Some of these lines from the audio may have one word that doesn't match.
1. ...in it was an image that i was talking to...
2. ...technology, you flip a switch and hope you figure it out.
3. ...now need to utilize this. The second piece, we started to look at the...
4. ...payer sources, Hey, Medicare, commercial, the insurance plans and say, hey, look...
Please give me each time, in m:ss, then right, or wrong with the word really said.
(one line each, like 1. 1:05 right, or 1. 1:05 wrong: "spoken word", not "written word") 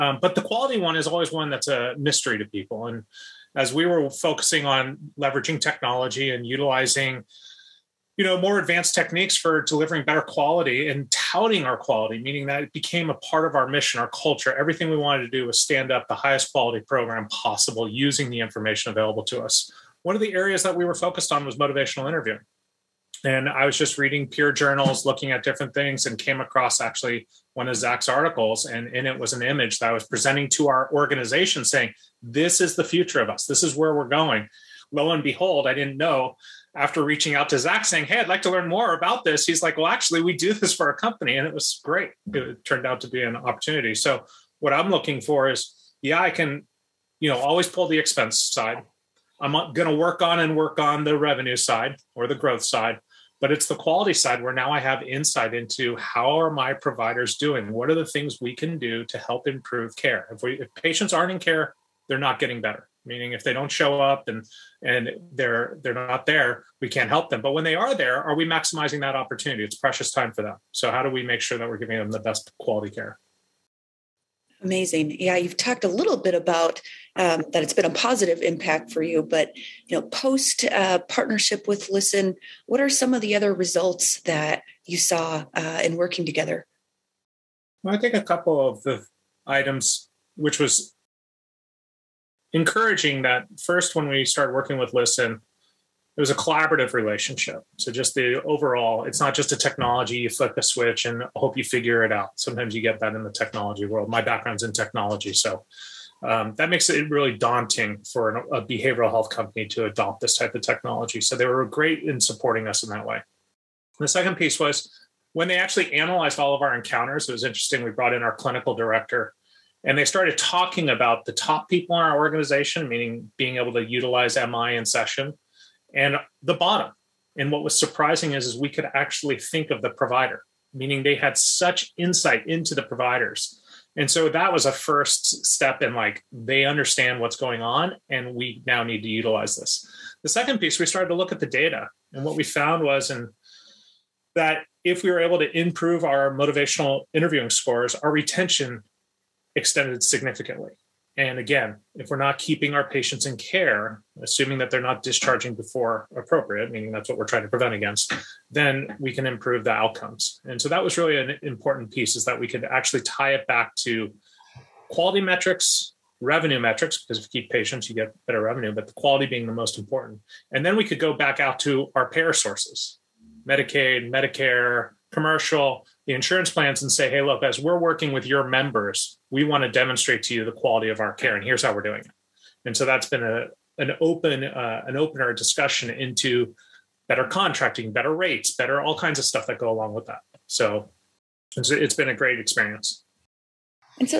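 1. 0:28 wrong: "presenting", not "talking"
2. 1:39 right
3. 2:18 right
4. 2:52 wrong: "Medicaid", not "Hey".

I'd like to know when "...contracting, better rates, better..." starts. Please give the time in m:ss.
3:07.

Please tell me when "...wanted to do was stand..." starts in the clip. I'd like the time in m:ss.
0:14.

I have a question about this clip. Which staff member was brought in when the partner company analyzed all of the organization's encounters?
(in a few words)
Clinical director.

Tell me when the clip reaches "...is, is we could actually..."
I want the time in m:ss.
2:08.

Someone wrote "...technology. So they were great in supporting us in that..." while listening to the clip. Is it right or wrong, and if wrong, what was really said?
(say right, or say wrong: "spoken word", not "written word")
right.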